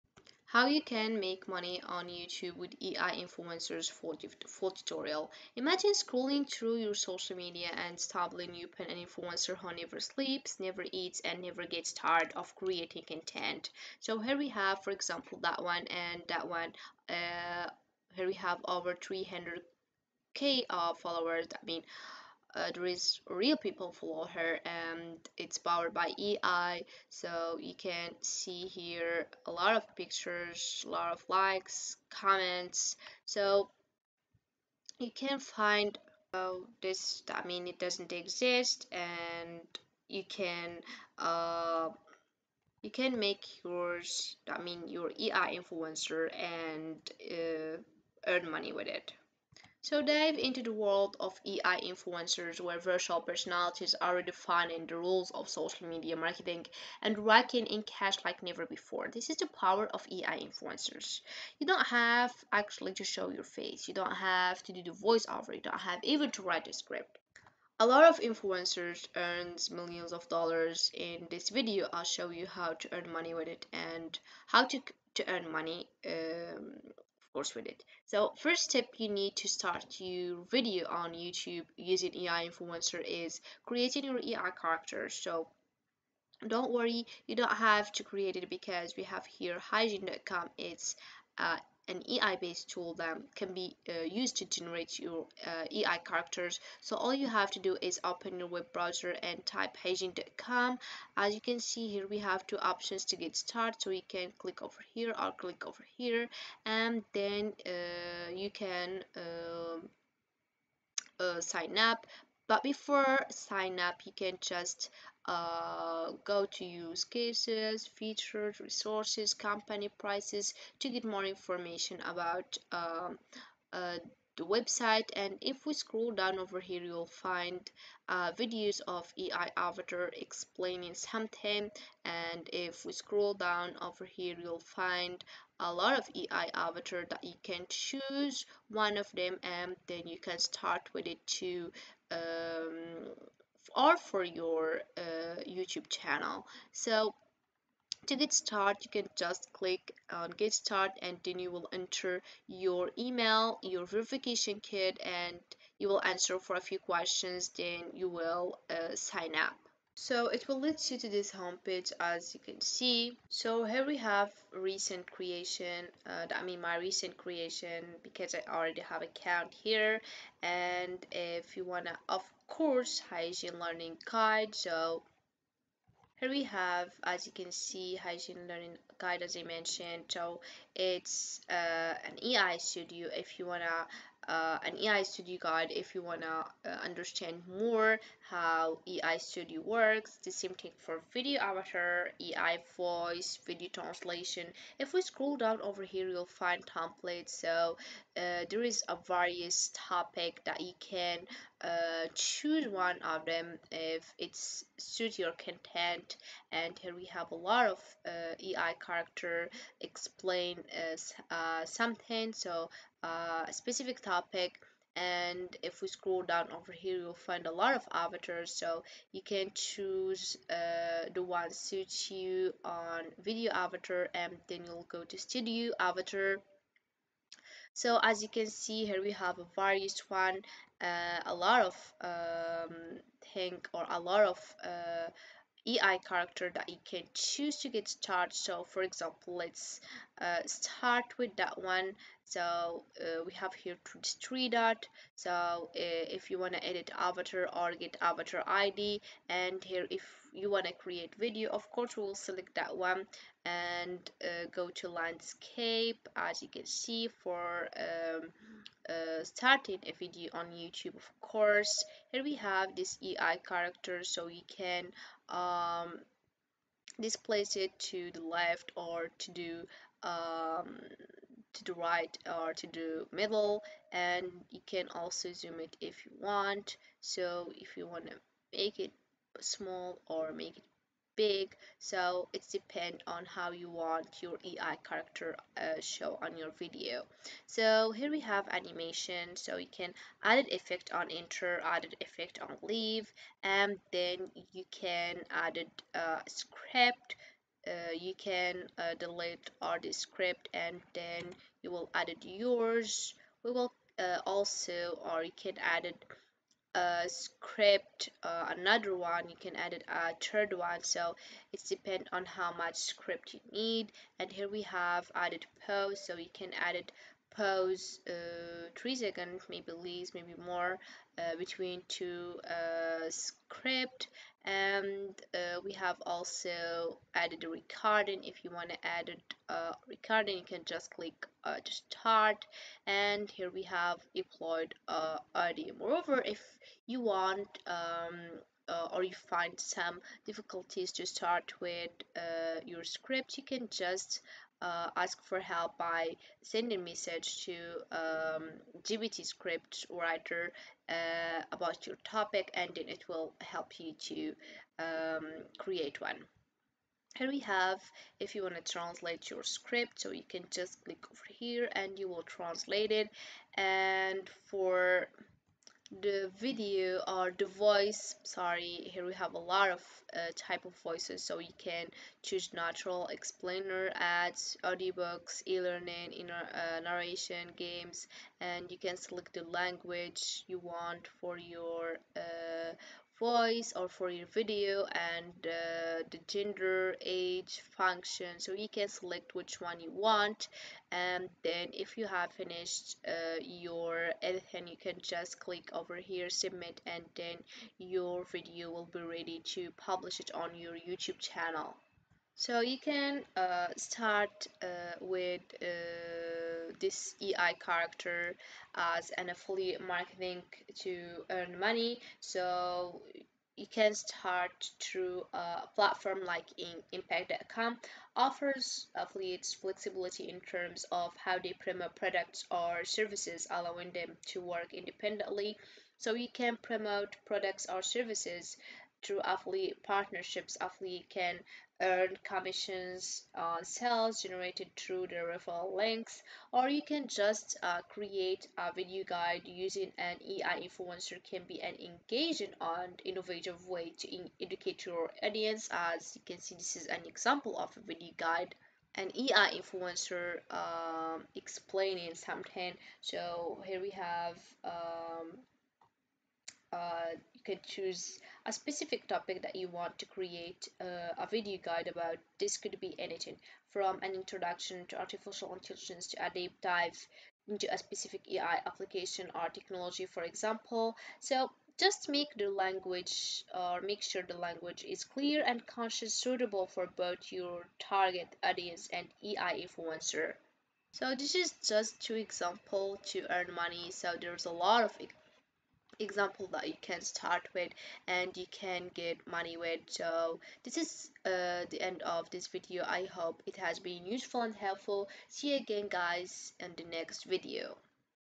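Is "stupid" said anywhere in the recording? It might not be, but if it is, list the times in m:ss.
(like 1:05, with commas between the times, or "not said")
not said.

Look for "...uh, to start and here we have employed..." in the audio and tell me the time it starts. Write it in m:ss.
5:31.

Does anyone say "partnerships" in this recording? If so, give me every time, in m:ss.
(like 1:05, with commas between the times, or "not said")
7:09.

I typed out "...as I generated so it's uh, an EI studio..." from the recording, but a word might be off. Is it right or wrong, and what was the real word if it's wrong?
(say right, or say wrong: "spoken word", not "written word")
wrong: "mentioned", not "generated".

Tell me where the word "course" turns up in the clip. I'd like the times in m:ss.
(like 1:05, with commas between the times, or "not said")
1:17, 2:52, 4:11, 4:21.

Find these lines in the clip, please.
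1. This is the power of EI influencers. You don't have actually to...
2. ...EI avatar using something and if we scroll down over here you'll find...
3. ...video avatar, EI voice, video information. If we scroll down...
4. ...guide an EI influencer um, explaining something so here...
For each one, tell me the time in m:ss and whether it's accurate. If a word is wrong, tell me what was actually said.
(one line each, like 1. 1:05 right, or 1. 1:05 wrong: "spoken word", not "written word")
1. 0:59 right
2. 2:09 wrong: "explaining", not "using"
3. 3:11 wrong: "translation", not "information"
4. 7:28 right.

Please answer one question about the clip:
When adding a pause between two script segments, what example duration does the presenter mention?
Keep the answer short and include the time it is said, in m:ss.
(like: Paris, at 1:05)
3 seconds, at 5:18.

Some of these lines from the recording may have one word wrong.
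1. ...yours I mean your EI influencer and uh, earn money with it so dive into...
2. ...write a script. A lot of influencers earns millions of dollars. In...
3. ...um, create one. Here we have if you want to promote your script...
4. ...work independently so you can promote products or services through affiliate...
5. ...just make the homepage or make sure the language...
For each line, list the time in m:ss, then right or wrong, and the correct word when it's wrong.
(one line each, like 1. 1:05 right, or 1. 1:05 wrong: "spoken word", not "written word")
1. 0:43 right
2. 1:06 right
3. 5:54 wrong: "translate", not "promote"
4. 7:04 right
5. 7:51 wrong: "language", not "homepage".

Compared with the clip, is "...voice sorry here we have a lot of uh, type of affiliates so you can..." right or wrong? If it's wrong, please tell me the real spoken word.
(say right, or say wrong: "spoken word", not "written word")
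wrong: "voices", not "affiliates".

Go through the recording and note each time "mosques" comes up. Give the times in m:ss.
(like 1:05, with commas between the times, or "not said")
not said.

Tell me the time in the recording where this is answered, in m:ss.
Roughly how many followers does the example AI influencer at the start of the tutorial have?
0:18.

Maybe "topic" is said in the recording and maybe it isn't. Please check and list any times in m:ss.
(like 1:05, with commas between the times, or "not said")
3:19, 3:33, 5:52, 7:39.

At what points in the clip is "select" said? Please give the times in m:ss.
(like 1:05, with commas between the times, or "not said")
4:12, 6:18, 6:28.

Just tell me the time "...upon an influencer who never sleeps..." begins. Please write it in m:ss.
0:08.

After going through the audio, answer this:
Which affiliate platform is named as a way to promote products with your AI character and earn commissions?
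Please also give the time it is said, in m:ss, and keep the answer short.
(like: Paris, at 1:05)
impact.com, at 6:56.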